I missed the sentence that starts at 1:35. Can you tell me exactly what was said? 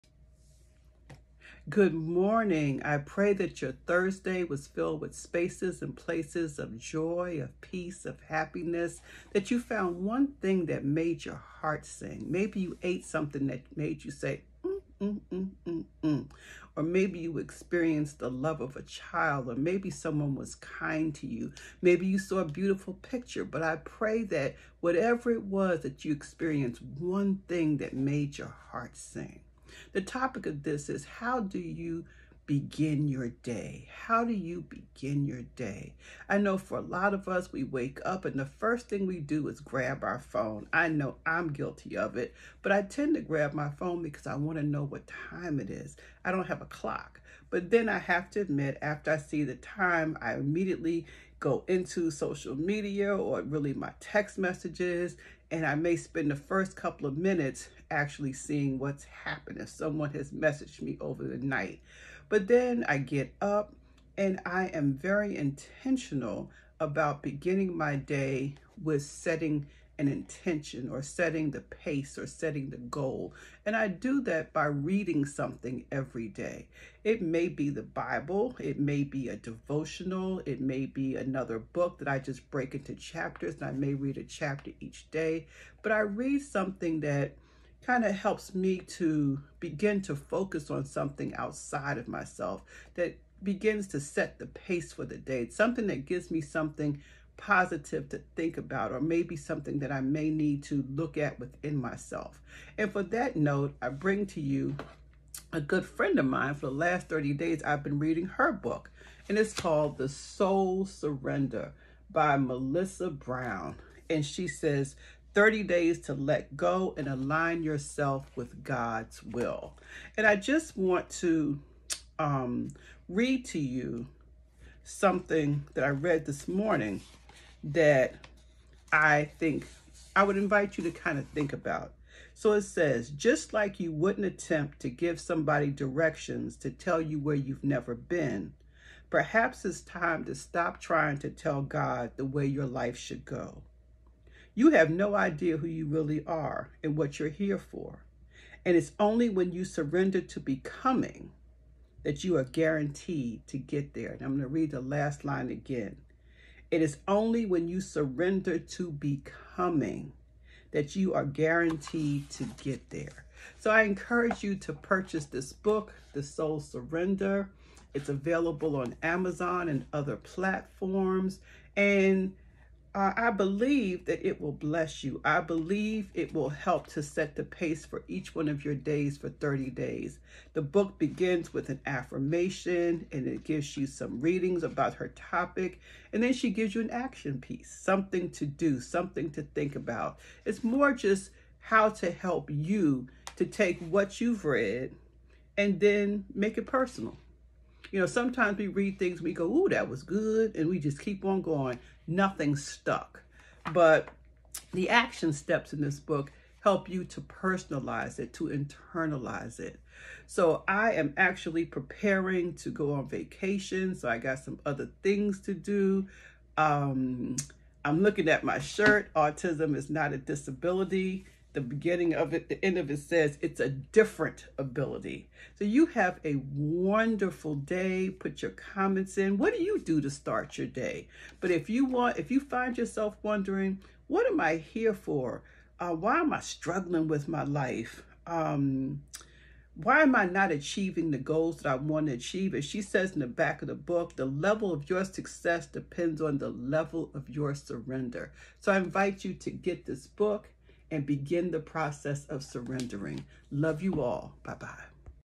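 It's something that gives me something positive to think about, or maybe something that I may need to look at within myself.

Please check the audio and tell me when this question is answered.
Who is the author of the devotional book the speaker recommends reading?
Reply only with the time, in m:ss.
1:52.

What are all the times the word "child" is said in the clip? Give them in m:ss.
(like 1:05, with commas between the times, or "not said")
0:18.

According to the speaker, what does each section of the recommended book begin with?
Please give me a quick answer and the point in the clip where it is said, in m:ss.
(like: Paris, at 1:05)
An affirmation, at 3:01.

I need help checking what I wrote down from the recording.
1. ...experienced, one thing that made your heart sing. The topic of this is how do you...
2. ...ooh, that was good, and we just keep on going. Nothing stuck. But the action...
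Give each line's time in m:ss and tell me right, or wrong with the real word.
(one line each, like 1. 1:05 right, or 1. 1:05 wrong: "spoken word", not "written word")
1. 0:26 right
2. 3:19 right.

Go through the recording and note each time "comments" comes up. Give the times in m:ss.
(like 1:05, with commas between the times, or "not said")
3:48.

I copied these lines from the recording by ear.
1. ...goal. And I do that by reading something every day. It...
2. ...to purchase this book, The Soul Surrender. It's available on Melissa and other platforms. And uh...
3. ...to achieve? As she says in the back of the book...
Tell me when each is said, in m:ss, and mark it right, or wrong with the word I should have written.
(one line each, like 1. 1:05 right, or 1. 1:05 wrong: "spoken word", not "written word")
1. 1:12 right
2. 2:44 wrong: "Amazon", not "Melissa"
3. 4:02 right.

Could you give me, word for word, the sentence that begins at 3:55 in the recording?
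Uh, why am I struggling with my life?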